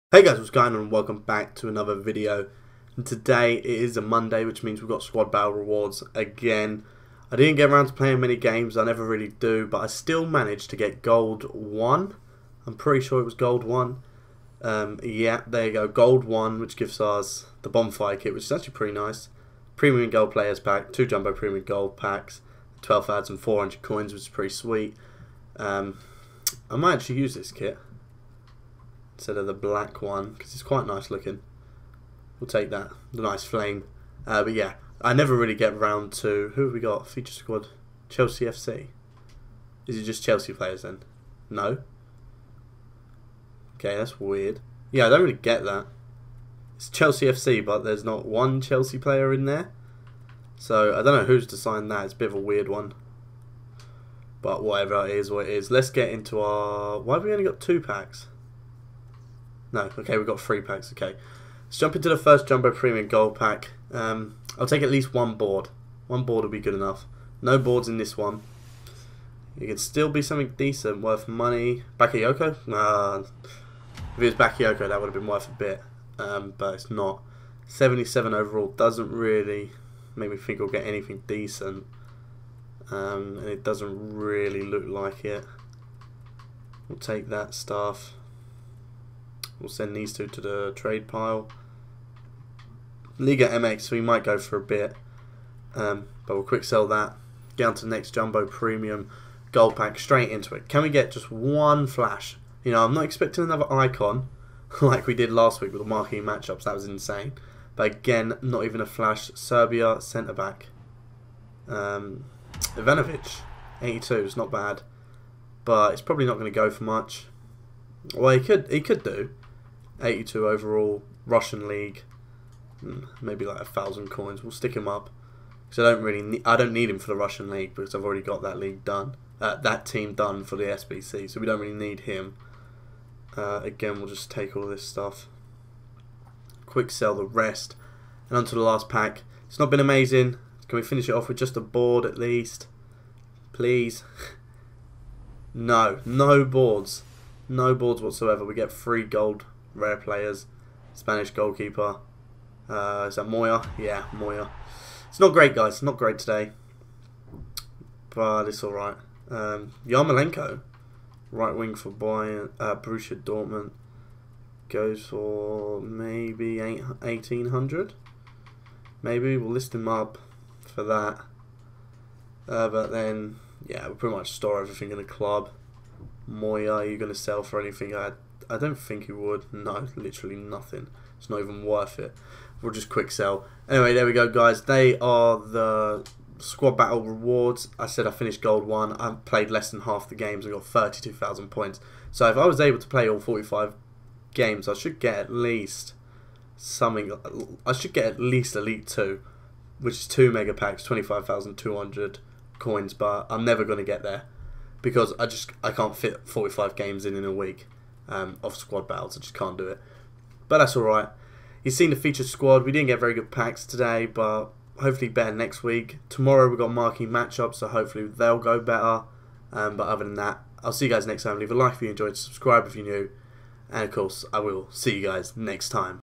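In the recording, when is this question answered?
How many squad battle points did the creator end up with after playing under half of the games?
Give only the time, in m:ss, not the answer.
3:10.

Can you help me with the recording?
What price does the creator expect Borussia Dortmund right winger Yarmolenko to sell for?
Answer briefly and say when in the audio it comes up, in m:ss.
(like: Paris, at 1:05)
1800, at 2:46.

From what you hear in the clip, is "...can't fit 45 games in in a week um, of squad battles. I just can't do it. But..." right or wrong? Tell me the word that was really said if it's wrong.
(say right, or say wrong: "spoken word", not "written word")
right.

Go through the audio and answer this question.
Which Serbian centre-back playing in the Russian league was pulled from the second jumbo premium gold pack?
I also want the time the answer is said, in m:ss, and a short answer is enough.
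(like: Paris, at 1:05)
Ivanovic, at 1:52.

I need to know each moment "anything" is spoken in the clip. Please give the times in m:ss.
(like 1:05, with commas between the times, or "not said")
1:20, 2:57.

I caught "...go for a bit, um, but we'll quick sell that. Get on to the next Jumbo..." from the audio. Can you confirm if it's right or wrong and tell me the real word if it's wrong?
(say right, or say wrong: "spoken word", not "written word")
right.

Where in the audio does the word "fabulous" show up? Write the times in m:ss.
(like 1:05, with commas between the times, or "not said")
not said.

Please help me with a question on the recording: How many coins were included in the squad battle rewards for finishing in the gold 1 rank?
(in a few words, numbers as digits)
12,400.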